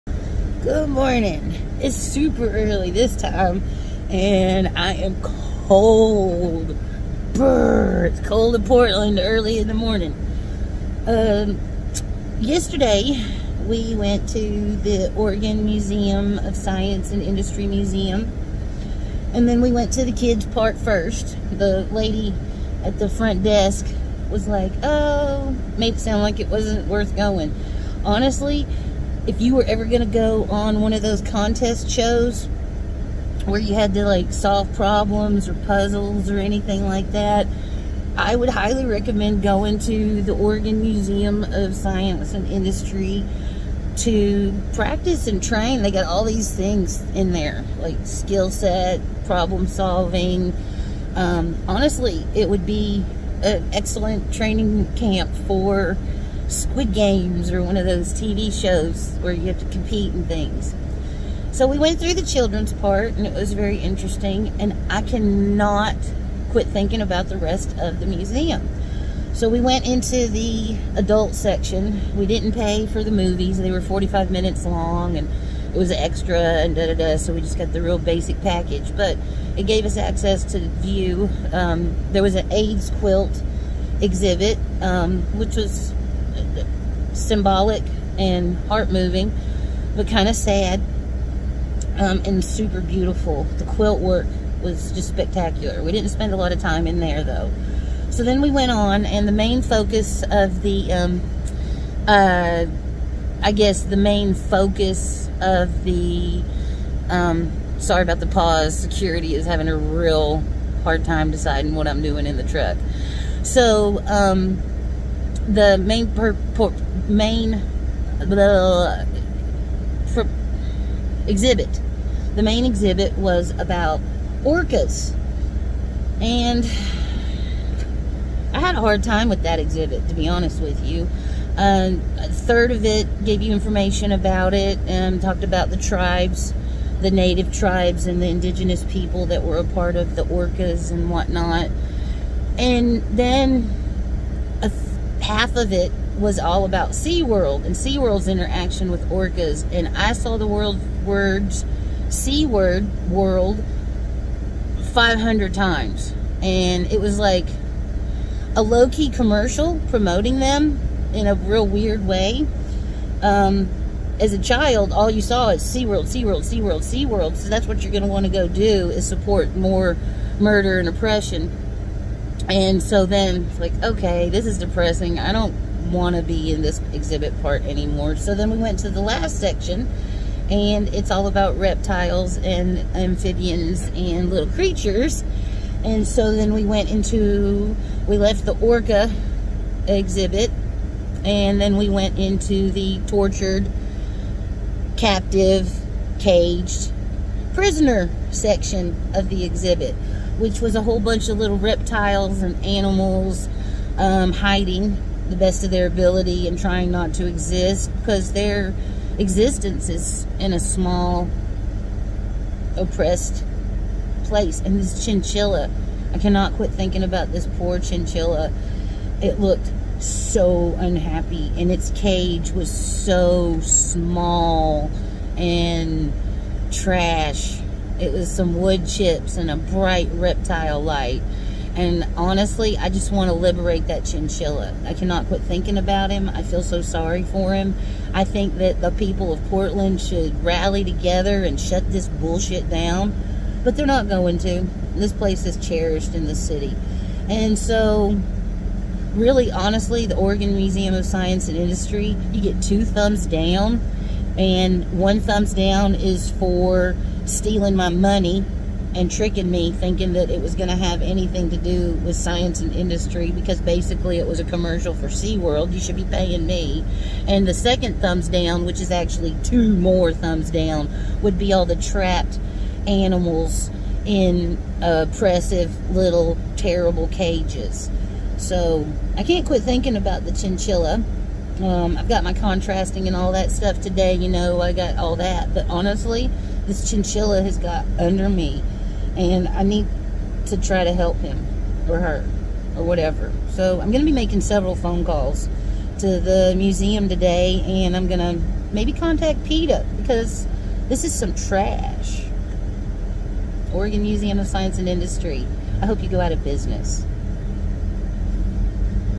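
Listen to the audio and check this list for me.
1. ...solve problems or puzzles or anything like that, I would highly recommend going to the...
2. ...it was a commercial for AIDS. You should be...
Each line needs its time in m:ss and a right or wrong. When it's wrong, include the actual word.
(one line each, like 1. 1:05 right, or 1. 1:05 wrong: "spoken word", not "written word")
1. 0:34 right
2. 4:24 wrong: "SeaWorld", not "AIDS".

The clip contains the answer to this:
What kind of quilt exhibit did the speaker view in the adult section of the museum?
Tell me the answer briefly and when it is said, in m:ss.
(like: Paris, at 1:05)
AIDS quilt, at 1:22.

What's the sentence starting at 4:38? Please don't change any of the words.
So I can't quit thinking about the chinchilla.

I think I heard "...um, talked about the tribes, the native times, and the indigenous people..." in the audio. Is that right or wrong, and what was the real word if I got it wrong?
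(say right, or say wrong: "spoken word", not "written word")
wrong: "tribes", not "times".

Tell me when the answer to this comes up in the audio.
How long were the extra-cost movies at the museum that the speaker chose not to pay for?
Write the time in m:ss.
1:13.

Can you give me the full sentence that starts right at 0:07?
Brr, it's cold in Portland early in the morning.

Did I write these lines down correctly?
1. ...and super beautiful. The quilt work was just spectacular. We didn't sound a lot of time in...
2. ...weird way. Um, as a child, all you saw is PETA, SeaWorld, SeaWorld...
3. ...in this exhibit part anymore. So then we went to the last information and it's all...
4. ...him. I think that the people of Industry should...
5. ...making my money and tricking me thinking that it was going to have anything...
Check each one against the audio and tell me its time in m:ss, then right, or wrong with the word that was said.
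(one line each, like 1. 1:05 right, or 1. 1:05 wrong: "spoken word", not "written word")
1. 1:32 wrong: "spend", not "sound"
2. 2:41 wrong: "SeaWorld", not "PETA"
3. 2:56 wrong: "section", not "information"
4. 3:57 wrong: "Portland", not "Industry"
5. 4:17 wrong: "stealing", not "making".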